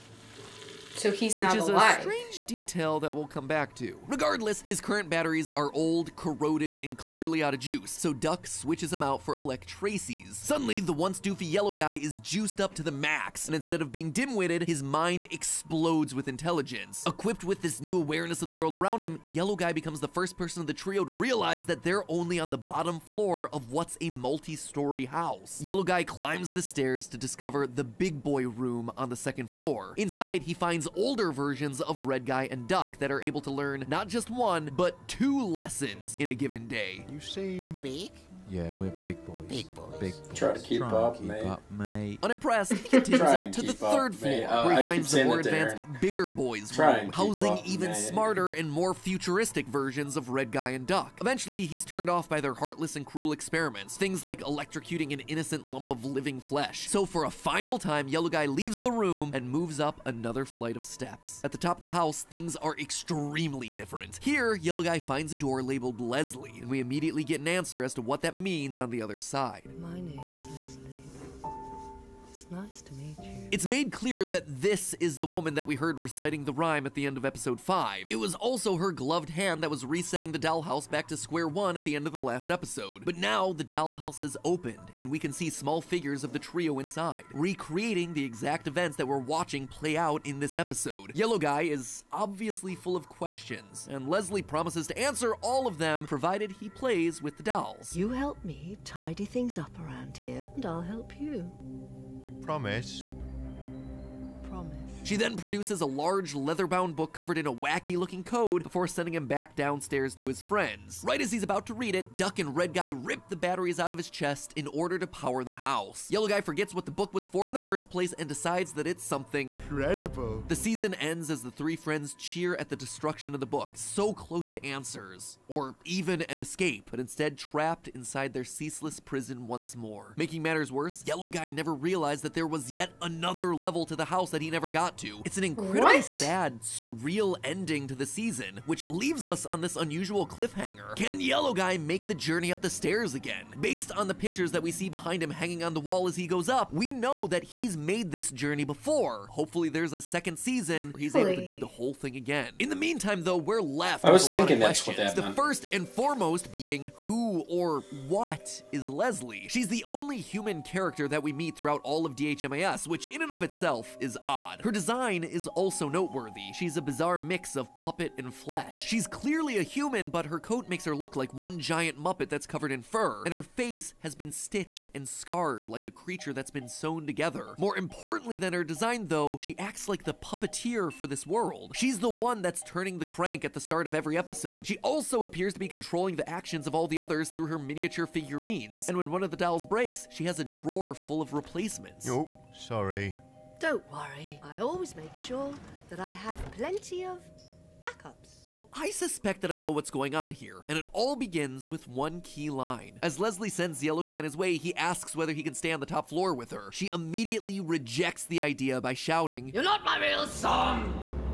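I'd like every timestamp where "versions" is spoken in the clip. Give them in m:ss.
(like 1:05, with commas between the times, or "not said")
0:31, 0:49.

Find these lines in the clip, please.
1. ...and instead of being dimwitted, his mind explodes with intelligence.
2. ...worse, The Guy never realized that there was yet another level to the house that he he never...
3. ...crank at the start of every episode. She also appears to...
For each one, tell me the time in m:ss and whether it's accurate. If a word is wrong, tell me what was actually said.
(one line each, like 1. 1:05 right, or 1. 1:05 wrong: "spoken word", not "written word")
1. 0:13 right
2. 2:10 wrong: "Yellow", not "The"
3. 3:03 right.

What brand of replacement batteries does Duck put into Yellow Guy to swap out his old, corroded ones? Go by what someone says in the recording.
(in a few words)
Electraces.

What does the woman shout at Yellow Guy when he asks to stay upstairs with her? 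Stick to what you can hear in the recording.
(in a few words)
My real son.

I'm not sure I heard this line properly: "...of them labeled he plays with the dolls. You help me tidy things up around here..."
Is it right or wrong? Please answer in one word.
wrong.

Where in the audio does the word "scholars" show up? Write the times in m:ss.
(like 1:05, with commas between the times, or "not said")
not said.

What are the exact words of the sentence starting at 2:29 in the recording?
Hopefully there's a second season where he's Hopefully.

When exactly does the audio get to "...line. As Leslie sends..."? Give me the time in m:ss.
3:22.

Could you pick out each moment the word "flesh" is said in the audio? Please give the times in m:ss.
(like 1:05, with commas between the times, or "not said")
0:56, 2:48.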